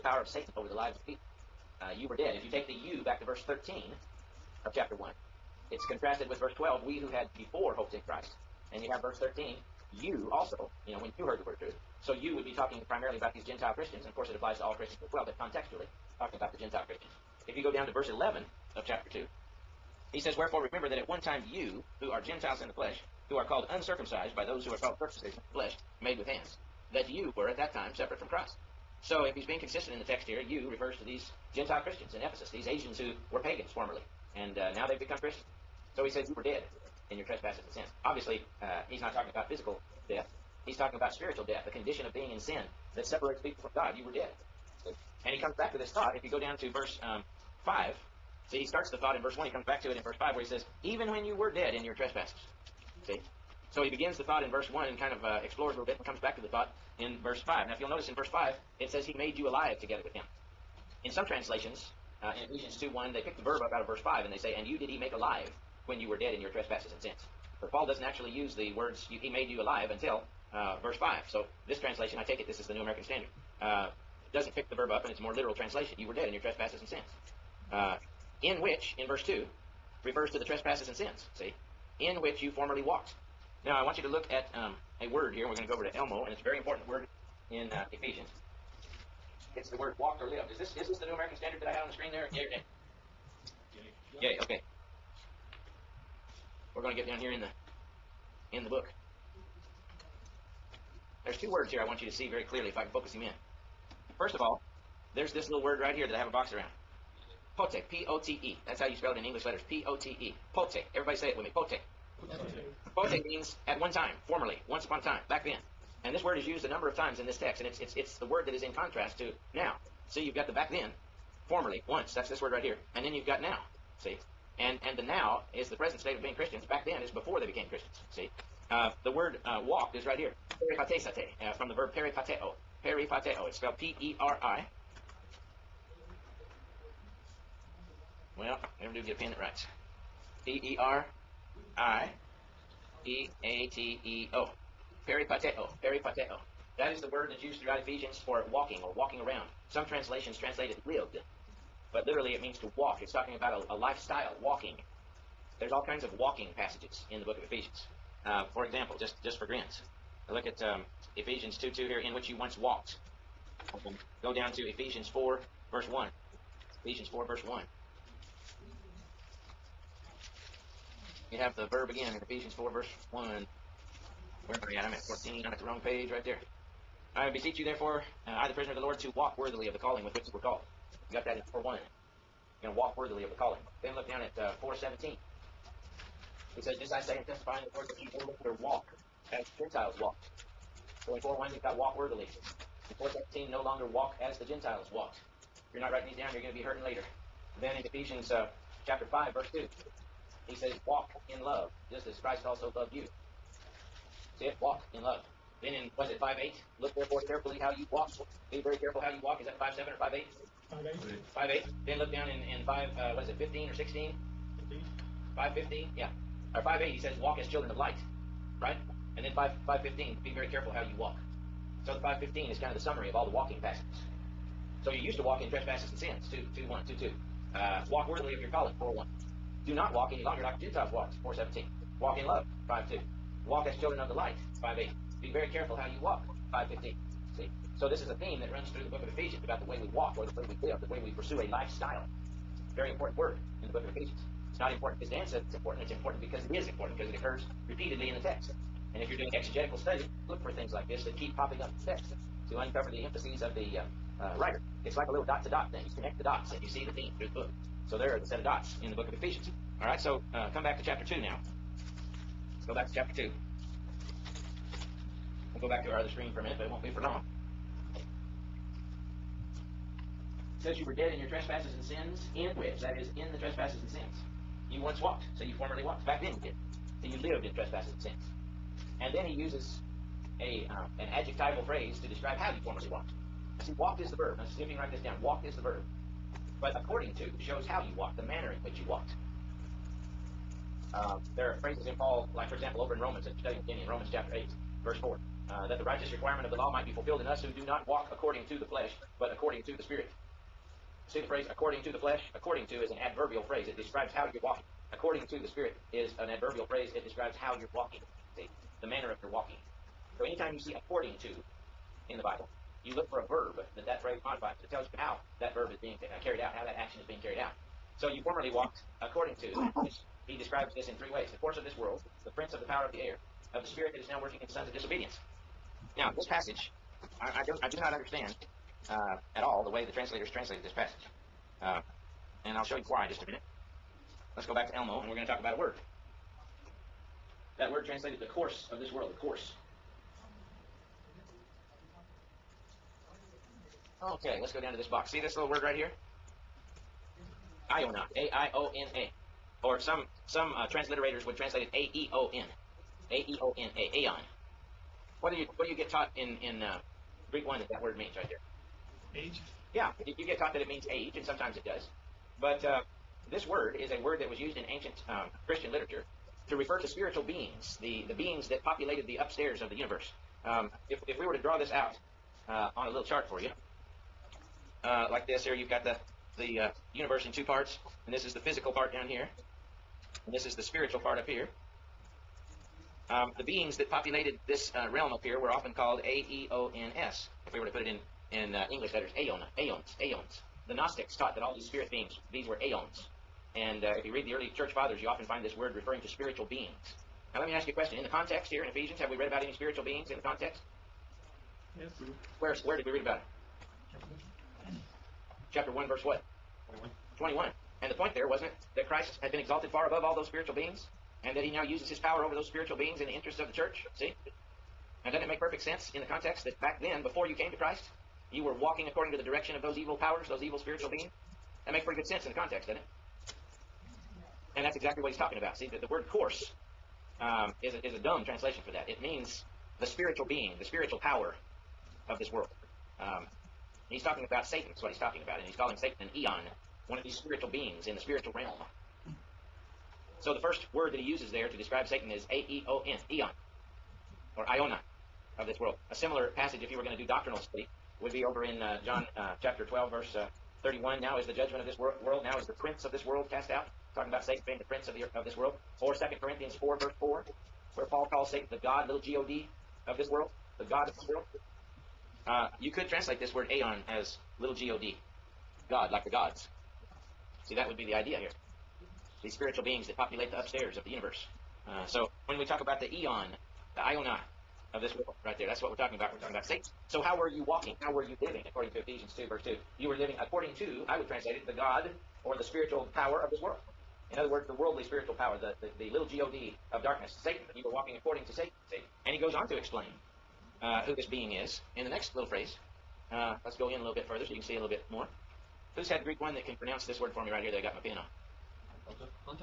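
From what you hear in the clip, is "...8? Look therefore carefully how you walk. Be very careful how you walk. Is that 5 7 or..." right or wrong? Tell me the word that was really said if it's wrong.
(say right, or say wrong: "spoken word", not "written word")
right.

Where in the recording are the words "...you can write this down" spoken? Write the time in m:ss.
4:44.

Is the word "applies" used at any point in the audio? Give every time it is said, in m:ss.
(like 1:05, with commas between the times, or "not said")
0:14.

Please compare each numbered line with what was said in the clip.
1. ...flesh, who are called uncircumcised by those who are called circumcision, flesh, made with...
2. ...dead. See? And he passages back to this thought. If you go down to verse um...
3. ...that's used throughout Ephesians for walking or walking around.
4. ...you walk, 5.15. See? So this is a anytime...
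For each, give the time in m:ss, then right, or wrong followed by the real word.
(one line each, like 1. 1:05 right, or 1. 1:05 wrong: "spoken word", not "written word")
1. 0:22 right
2. 0:44 wrong: "comes", not "passages"
3. 2:27 right
4. 3:55 wrong: "theme", not "anytime".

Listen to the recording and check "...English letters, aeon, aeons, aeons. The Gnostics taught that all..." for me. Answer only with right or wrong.
right.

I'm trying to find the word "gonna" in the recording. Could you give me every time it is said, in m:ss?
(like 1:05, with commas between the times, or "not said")
not said.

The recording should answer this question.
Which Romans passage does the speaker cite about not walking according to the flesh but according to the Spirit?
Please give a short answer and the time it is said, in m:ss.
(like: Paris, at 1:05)
Romans 8:4, at 4:53.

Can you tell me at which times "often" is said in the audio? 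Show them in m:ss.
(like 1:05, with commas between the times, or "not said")
6:25, 6:35.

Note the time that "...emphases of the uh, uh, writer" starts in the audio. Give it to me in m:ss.
4:13.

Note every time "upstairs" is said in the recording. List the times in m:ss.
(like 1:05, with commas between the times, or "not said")
6:09, 7:50.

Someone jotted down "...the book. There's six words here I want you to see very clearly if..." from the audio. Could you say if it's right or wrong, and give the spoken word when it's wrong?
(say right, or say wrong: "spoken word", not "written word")
wrong: "two", not "six".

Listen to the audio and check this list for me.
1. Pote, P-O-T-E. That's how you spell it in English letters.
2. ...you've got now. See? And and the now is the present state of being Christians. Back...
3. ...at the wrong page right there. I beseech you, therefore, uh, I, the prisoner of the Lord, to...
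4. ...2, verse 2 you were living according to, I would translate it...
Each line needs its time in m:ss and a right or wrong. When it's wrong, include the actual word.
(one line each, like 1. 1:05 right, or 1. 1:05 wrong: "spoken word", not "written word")
1. 1:47 right
2. 2:03 right
3. 2:55 right
4. 7:59 right.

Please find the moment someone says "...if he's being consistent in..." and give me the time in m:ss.
0:29.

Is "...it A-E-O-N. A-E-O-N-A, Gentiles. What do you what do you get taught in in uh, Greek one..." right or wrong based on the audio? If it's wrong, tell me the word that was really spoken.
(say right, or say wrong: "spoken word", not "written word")
wrong: "Aeon", not "Gentiles".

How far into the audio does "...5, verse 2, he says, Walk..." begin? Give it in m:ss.
3:19.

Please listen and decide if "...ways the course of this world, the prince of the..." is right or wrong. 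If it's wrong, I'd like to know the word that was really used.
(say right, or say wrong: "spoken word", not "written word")
right.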